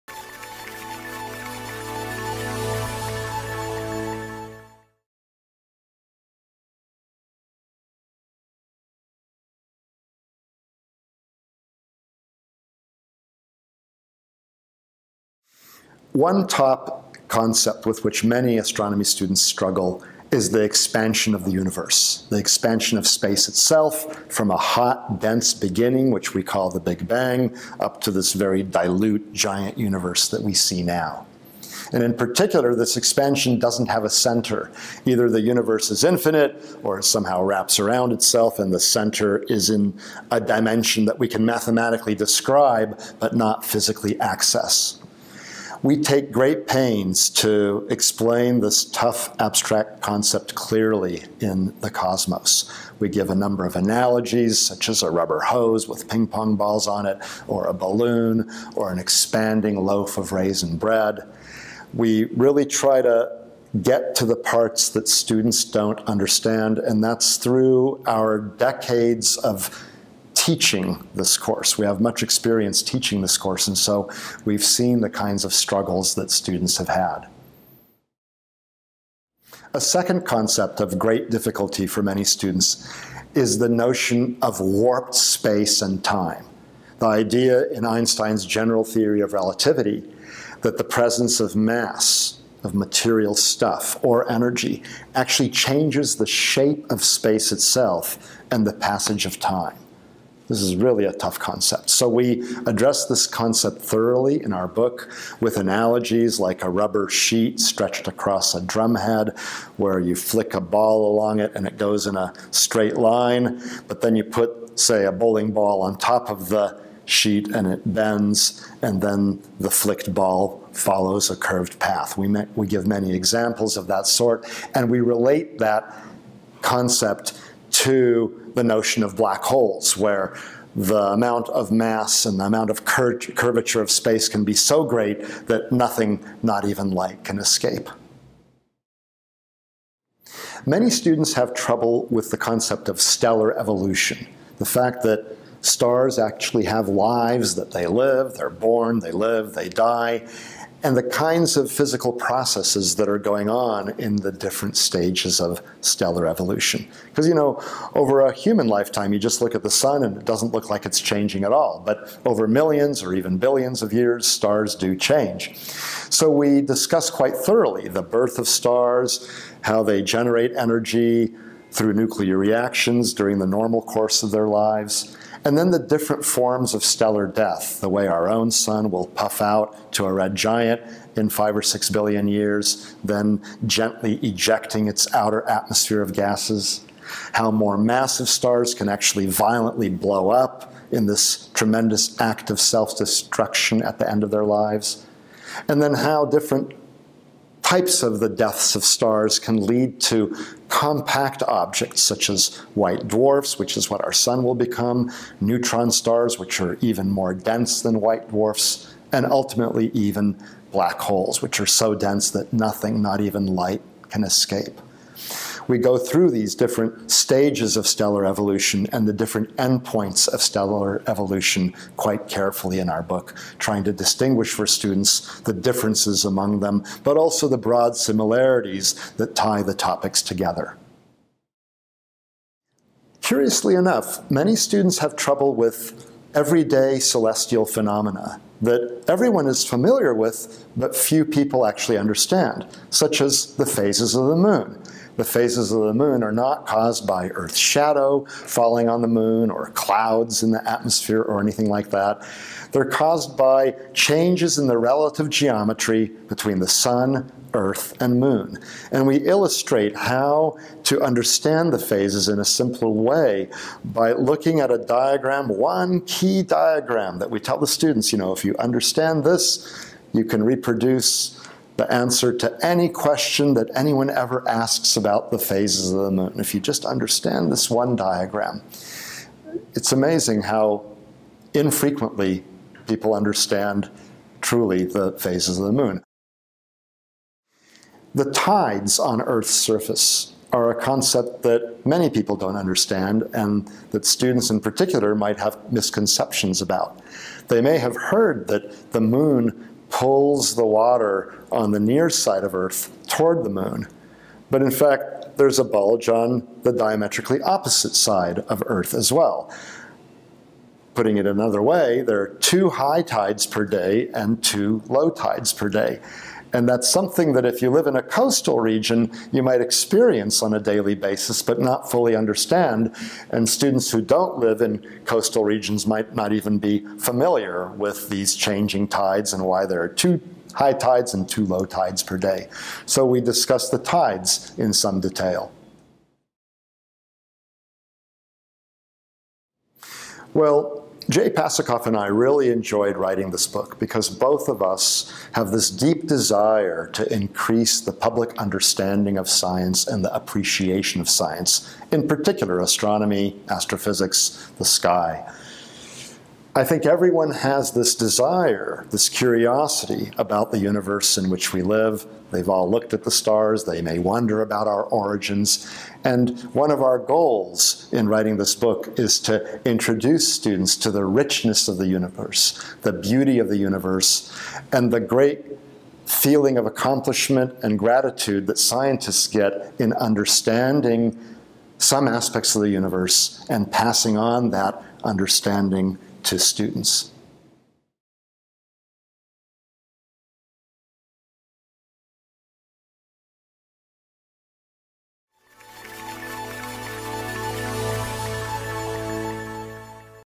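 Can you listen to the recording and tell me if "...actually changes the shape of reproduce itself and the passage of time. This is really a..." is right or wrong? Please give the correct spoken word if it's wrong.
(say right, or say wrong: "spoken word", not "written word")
wrong: "space", not "reproduce".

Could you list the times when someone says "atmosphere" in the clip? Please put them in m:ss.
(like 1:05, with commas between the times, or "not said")
3:05, 4:10.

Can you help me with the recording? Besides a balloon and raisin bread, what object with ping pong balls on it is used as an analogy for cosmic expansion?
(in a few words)
rubber hose.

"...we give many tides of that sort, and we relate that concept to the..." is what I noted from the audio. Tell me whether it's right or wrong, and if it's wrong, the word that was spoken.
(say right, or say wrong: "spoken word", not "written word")
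wrong: "examples", not "tides".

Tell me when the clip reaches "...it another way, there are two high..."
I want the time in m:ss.
5:11.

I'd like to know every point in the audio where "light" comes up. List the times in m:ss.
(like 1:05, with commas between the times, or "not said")
2:16, 3:33.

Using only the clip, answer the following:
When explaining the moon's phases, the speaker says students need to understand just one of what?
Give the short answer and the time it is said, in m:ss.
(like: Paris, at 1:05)
one key diagram, at 4:25.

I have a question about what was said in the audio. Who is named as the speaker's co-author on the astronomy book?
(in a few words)
Jay Pasachoff.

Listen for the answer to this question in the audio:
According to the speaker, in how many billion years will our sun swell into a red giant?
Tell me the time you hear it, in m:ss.
3:01.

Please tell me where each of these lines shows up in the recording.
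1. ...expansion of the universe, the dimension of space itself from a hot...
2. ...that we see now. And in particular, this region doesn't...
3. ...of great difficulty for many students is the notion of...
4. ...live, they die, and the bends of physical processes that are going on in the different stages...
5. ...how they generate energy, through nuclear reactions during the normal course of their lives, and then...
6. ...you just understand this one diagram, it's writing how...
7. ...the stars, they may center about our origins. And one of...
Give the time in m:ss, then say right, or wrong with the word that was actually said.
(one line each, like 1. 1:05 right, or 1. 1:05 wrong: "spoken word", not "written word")
1. 0:20 wrong: "expansion", not "dimension"
2. 0:30 wrong: "expansion", not "region"
3. 1:20 right
4. 2:29 wrong: "kinds", not "bends"
5. 2:49 right
6. 4:36 wrong: "amazing", not "writing"
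7. 6:03 wrong: "wonder", not "center".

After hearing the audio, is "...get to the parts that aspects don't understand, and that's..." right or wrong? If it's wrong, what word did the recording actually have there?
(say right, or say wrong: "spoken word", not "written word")
wrong: "students", not "aspects".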